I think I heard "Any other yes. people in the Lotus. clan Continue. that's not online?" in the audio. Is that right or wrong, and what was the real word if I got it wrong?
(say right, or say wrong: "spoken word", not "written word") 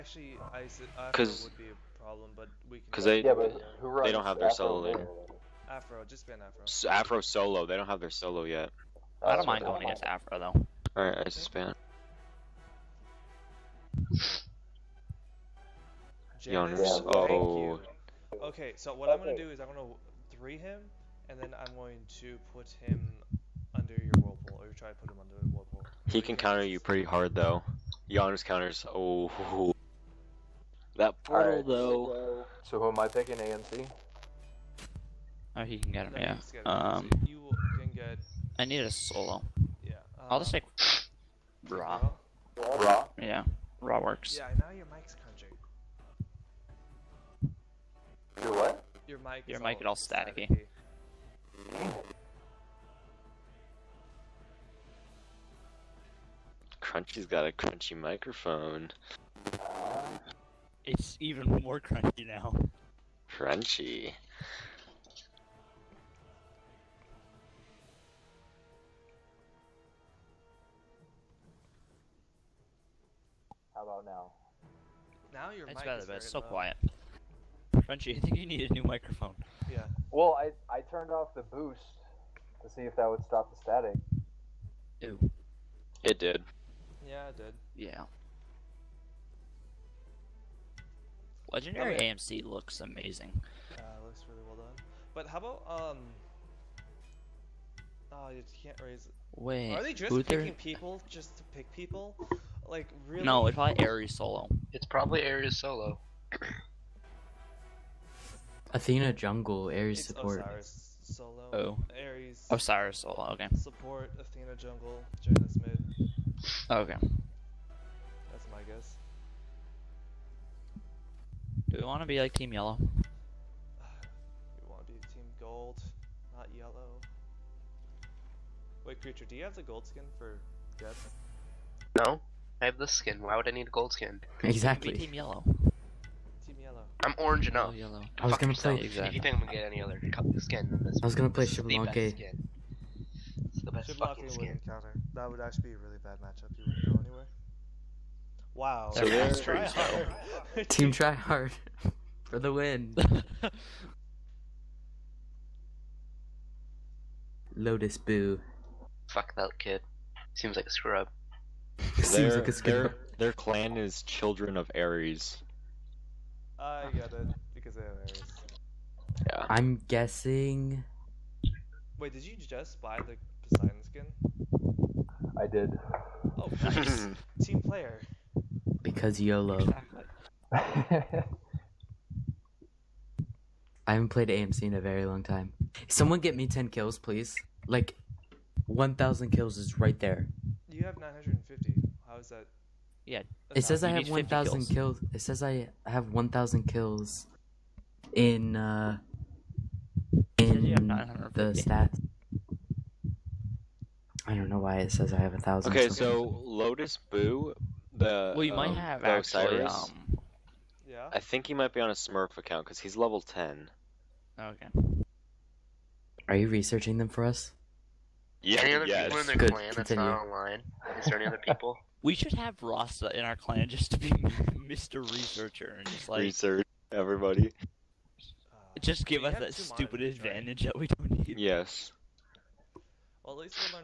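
wrong: "Good", not "Lotus".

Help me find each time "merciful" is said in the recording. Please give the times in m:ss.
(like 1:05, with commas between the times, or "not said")
not said.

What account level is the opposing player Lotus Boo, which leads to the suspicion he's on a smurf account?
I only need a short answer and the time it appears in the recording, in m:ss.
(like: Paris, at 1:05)
10, at 3:32.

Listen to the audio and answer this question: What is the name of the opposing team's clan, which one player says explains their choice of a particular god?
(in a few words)
Children of Ares.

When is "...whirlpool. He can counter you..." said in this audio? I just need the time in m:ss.
0:24.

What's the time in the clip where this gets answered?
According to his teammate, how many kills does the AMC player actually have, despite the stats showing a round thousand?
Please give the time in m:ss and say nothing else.
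3:10.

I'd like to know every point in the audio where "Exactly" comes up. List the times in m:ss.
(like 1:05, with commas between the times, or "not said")
2:14, 2:18, 2:59.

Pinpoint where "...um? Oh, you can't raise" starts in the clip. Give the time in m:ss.
1:35.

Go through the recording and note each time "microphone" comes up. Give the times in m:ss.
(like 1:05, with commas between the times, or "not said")
0:57, 1:18.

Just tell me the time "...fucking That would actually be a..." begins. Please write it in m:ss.
2:23.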